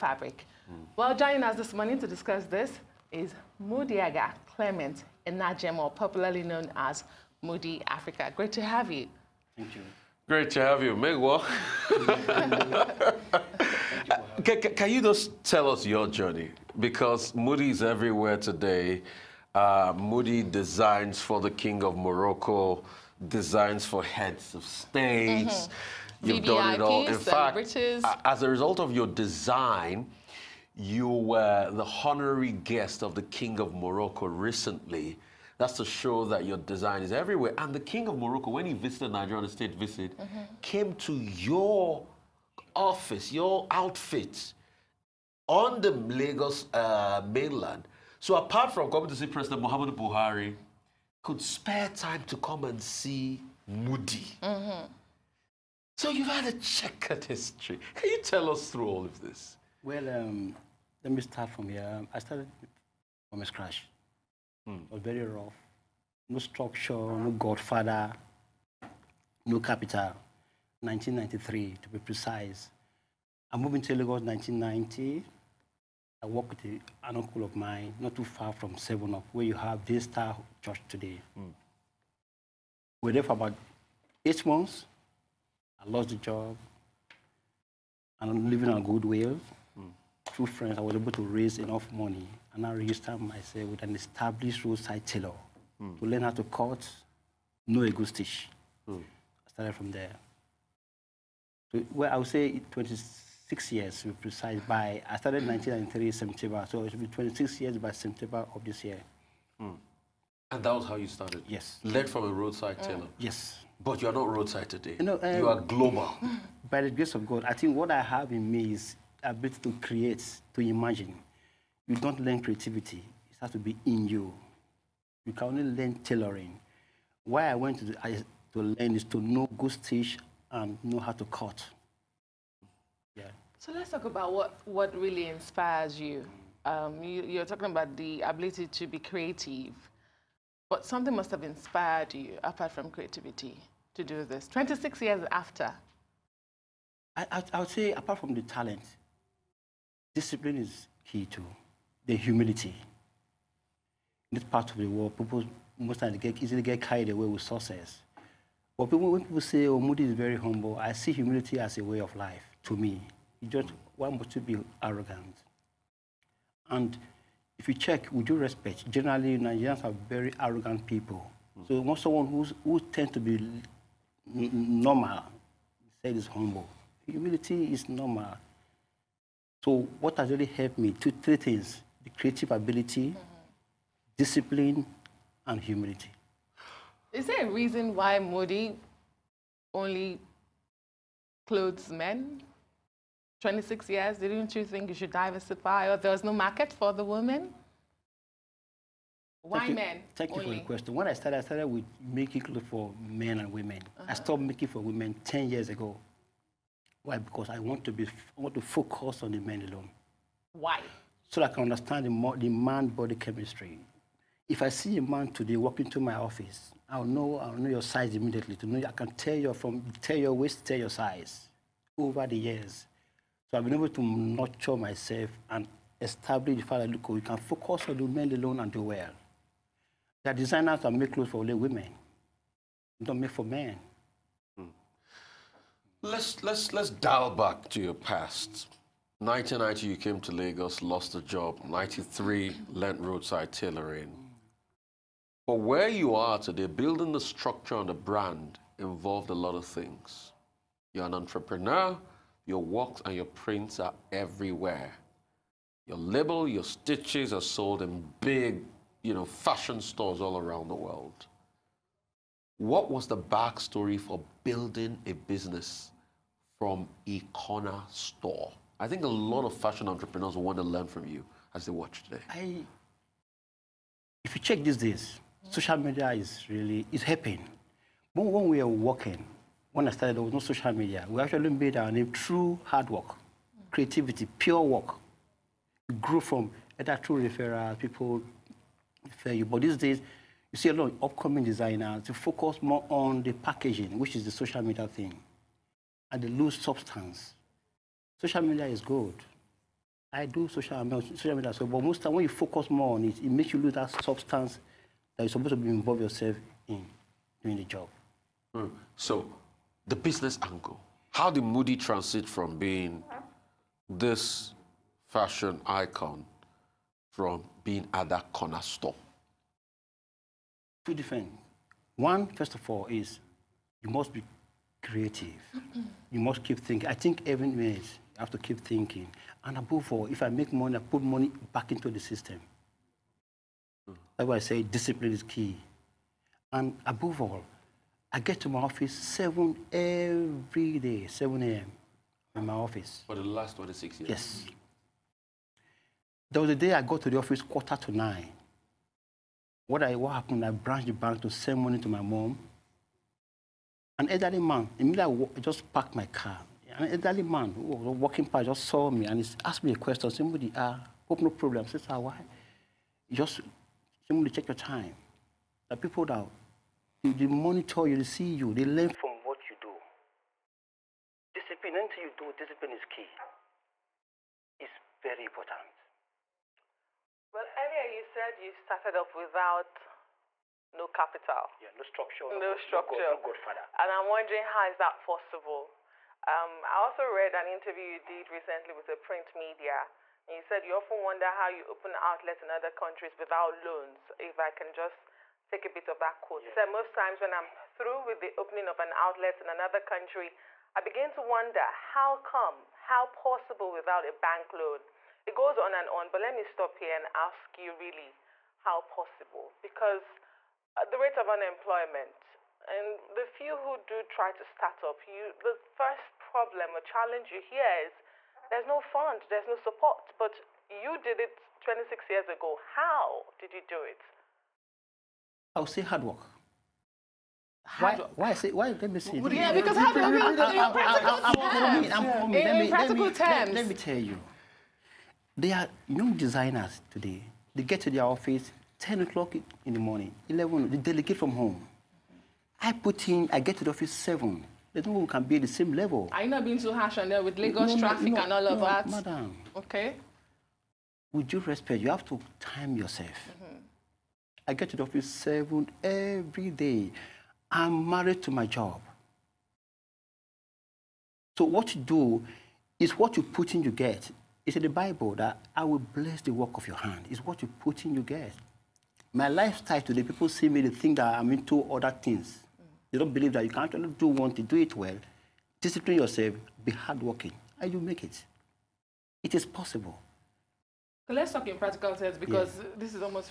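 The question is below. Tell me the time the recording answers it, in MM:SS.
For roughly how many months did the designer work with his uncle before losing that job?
01:24.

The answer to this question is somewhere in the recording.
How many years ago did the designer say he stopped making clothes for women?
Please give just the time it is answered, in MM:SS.
03:25.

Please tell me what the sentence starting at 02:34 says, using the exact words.
In this part of the world, people most times get easily get carried away with success.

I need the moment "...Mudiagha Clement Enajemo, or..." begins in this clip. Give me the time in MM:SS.
00:03.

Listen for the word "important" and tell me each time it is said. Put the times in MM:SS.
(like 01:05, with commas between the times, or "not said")
06:15.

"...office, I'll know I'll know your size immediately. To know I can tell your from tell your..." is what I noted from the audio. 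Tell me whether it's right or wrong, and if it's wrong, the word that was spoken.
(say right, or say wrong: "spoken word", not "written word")
right.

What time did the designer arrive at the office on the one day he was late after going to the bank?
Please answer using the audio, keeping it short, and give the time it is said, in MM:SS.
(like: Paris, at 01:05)
Quarter to nine, at 05:47.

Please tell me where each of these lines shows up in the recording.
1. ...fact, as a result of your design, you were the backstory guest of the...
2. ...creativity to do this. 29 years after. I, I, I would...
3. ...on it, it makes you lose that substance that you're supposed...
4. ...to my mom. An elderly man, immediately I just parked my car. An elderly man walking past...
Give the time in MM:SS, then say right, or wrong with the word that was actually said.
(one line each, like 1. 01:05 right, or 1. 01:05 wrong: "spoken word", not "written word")
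1. 00:27 wrong: "honorary", not "backstory"
2. 02:22 wrong: "26", not "29"
3. 05:02 right
4. 05:51 right.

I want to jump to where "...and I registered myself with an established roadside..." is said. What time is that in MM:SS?
01:32.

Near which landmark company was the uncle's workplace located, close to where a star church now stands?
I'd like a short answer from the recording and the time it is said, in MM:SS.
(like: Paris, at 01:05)
Seven Up, at 01:18.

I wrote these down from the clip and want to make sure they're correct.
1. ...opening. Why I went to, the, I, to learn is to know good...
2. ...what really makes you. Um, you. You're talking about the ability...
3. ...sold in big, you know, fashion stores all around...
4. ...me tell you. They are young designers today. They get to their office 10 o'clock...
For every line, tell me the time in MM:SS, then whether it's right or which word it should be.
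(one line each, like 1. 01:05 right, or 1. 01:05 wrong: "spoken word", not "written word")
1. 02:06 wrong: "tailoring", not "opening"
2. 02:14 wrong: "inspires", not "makes"
3. 04:17 right
4. 07:13 right.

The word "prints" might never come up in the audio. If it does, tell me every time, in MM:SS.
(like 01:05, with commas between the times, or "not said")
04:13, 06:28.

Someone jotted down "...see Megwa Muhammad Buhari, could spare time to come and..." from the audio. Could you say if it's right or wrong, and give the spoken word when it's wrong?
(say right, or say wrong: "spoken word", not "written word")
wrong: "President", not "Megwa".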